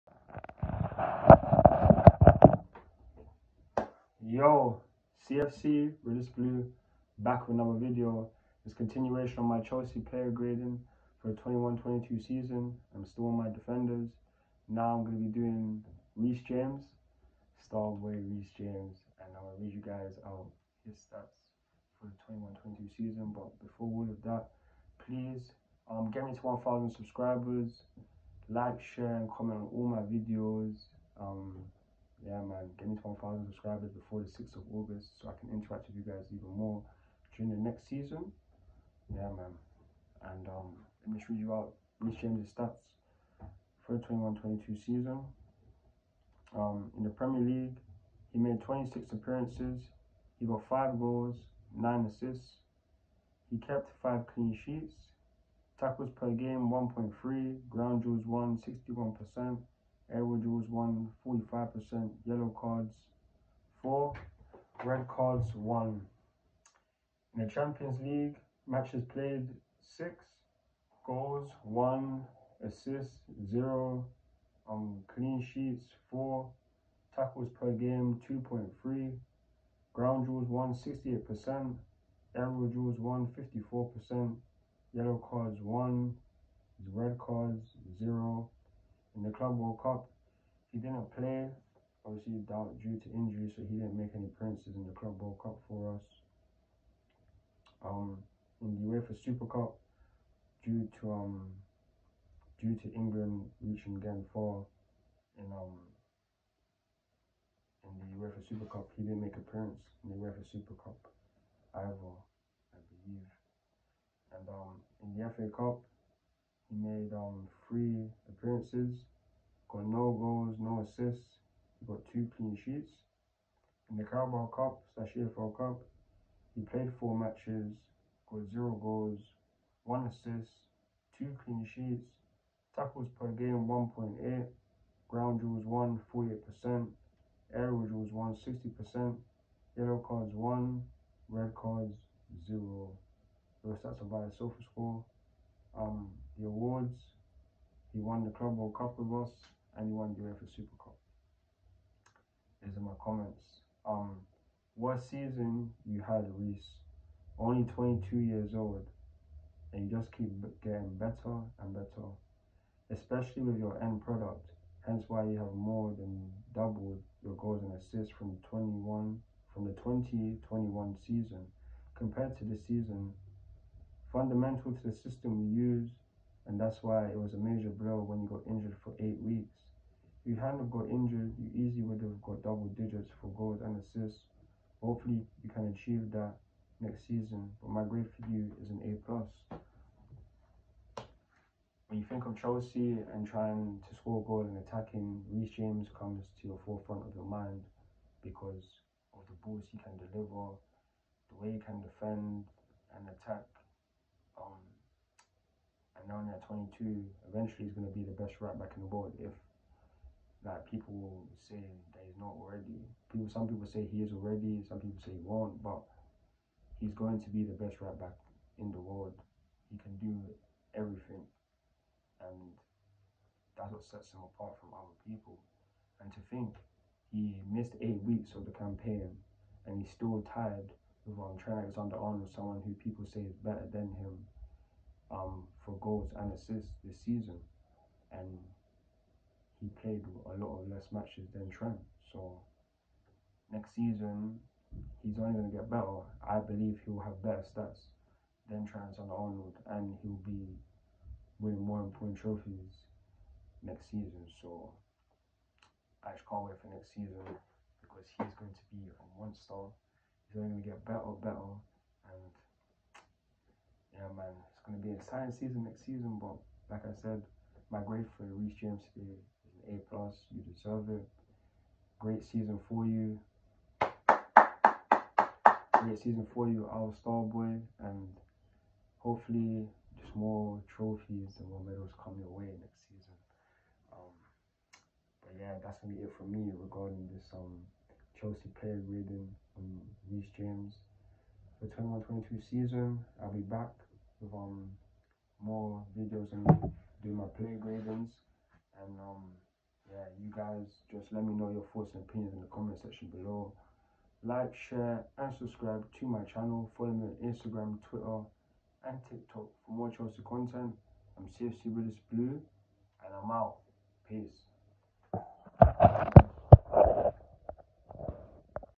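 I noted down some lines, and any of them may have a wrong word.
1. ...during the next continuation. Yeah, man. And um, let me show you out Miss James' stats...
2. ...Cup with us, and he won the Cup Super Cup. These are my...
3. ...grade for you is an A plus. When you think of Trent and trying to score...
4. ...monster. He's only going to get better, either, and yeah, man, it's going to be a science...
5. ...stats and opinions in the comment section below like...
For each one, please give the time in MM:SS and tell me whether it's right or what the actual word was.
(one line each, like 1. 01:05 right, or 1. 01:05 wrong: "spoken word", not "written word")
1. 00:37 wrong: "season", not "continuation"
2. 02:28 wrong: "UEFA", not "Cup"
3. 03:07 wrong: "Chelsea", not "Trent"
4. 04:19 wrong: "better", not "either"
5. 05:01 wrong: "thoughts", not "stats".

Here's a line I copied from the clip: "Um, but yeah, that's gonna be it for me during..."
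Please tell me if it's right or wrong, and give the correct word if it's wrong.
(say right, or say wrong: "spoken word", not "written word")
wrong: "regarding", not "during".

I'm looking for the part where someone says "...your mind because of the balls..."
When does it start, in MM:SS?
03:17.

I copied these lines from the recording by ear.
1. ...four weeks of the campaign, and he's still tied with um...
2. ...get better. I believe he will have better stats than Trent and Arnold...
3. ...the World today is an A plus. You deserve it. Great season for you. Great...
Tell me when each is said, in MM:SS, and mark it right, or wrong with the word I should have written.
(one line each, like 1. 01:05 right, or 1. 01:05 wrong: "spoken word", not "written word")
1. 03:47 wrong: "eight", not "four"
2. 04:05 right
3. 04:28 wrong: "James", not "World".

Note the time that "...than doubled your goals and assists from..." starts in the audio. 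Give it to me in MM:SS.
02:45.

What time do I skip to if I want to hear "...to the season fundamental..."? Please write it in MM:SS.
02:52.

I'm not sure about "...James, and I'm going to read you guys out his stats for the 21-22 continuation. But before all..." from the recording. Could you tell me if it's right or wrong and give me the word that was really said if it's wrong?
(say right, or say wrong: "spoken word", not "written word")
wrong: "season", not "continuation".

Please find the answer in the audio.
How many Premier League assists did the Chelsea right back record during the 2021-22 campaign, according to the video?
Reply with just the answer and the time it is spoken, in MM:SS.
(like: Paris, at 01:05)
9, at 00:51.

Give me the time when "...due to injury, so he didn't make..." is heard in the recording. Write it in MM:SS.
01:32.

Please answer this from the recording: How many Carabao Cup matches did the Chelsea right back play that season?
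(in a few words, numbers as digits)
4.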